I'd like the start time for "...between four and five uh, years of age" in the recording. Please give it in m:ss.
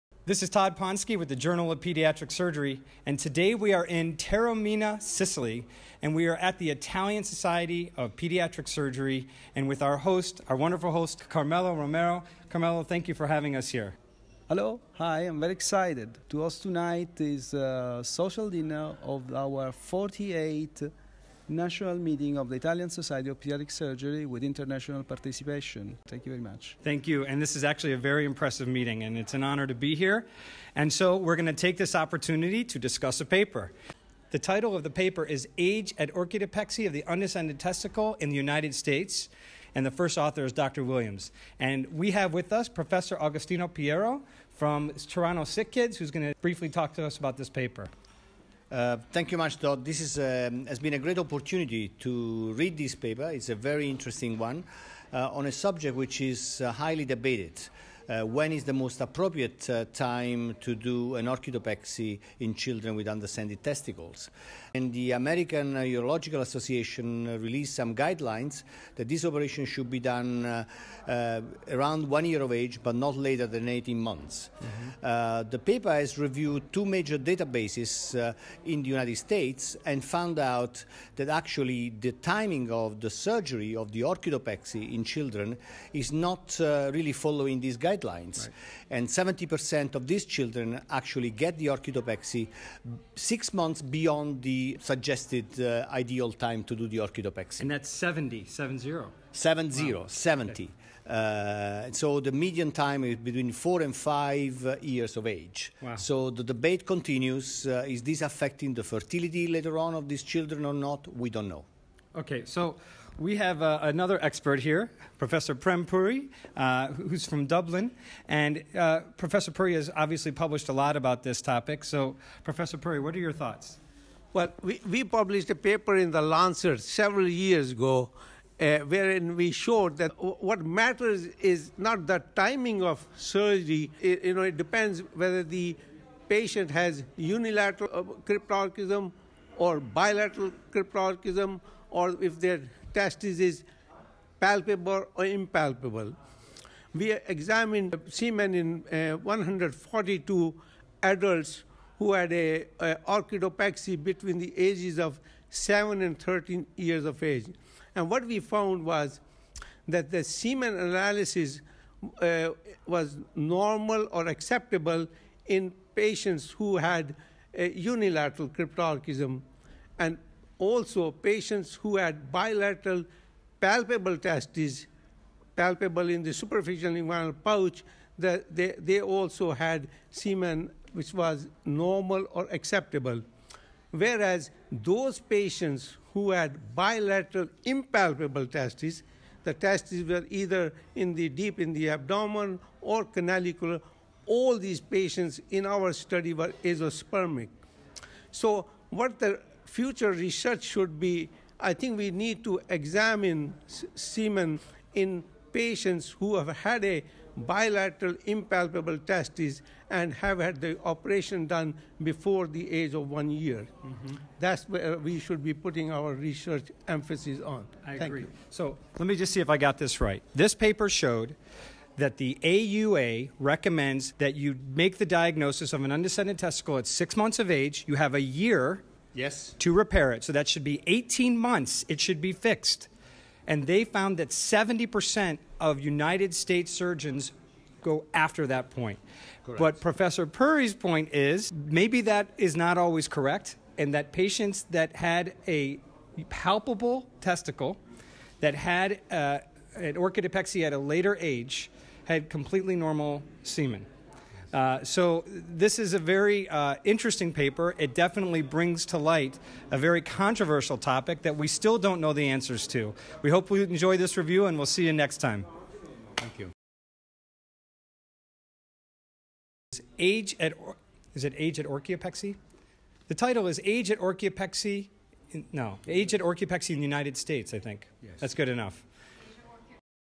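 1:43.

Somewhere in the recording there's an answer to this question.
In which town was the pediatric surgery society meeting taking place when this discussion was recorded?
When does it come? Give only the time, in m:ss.
0:04.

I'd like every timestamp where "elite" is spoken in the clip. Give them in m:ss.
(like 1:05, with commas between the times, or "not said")
not said.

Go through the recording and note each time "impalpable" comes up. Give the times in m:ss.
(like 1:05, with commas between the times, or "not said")
2:25, 3:07, 3:28.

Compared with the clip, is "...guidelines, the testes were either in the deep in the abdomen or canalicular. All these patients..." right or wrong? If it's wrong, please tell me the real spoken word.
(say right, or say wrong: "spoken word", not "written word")
wrong: "testes", not "guidelines".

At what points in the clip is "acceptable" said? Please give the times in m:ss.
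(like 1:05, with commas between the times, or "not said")
2:44, 3:02.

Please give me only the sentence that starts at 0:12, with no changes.
Carmelo, thank you for having us here.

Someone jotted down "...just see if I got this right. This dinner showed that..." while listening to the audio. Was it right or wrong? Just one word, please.
wrong.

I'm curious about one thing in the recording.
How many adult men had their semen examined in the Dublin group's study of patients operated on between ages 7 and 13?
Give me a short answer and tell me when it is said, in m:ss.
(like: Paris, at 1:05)
142, at 2:29.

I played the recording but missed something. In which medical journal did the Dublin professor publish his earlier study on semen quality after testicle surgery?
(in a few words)
The Lancet.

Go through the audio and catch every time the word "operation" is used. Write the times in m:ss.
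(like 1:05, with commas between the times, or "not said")
1:09, 3:30.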